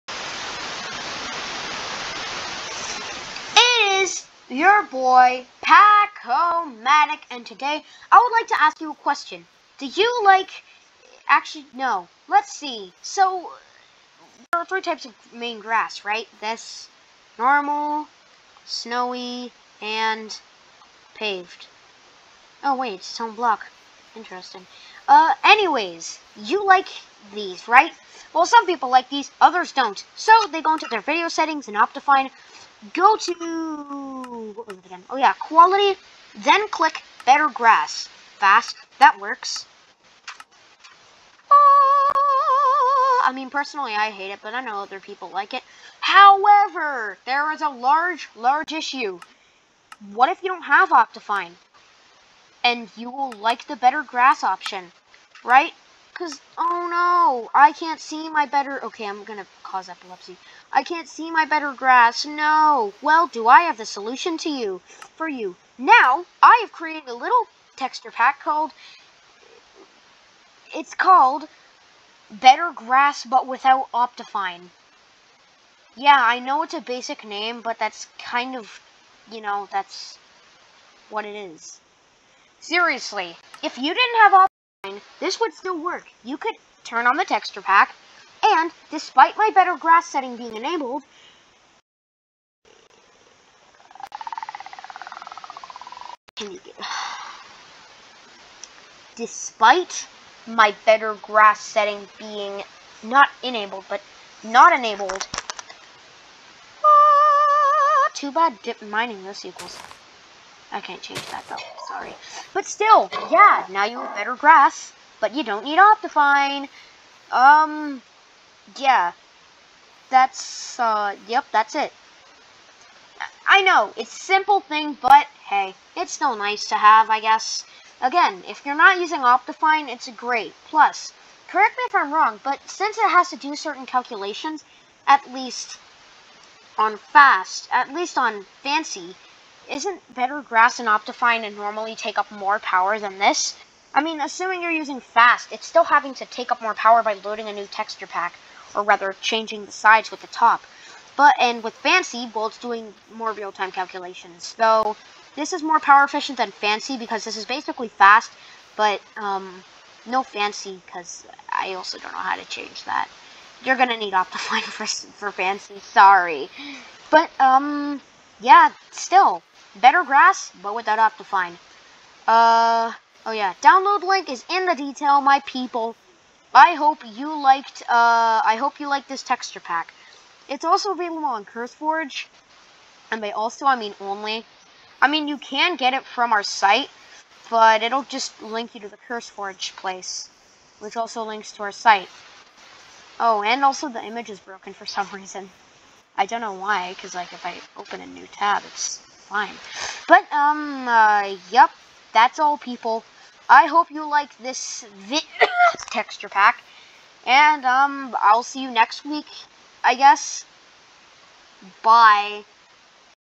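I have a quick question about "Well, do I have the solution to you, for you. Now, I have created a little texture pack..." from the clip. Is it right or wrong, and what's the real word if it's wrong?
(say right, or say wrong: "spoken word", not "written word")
right.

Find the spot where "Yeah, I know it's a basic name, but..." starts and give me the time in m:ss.
1:15.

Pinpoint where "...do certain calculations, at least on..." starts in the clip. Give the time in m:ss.
2:13.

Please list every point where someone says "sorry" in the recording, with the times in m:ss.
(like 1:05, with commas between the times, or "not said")
1:51, 2:45.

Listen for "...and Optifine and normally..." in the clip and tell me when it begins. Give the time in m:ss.
2:20.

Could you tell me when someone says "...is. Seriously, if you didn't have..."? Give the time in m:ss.
1:21.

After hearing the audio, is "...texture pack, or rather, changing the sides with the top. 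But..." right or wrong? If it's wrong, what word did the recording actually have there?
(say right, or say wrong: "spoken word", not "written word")
right.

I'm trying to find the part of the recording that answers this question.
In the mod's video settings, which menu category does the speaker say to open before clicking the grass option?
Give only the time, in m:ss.
0:35.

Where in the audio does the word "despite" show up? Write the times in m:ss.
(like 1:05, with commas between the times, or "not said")
1:28, 1:39.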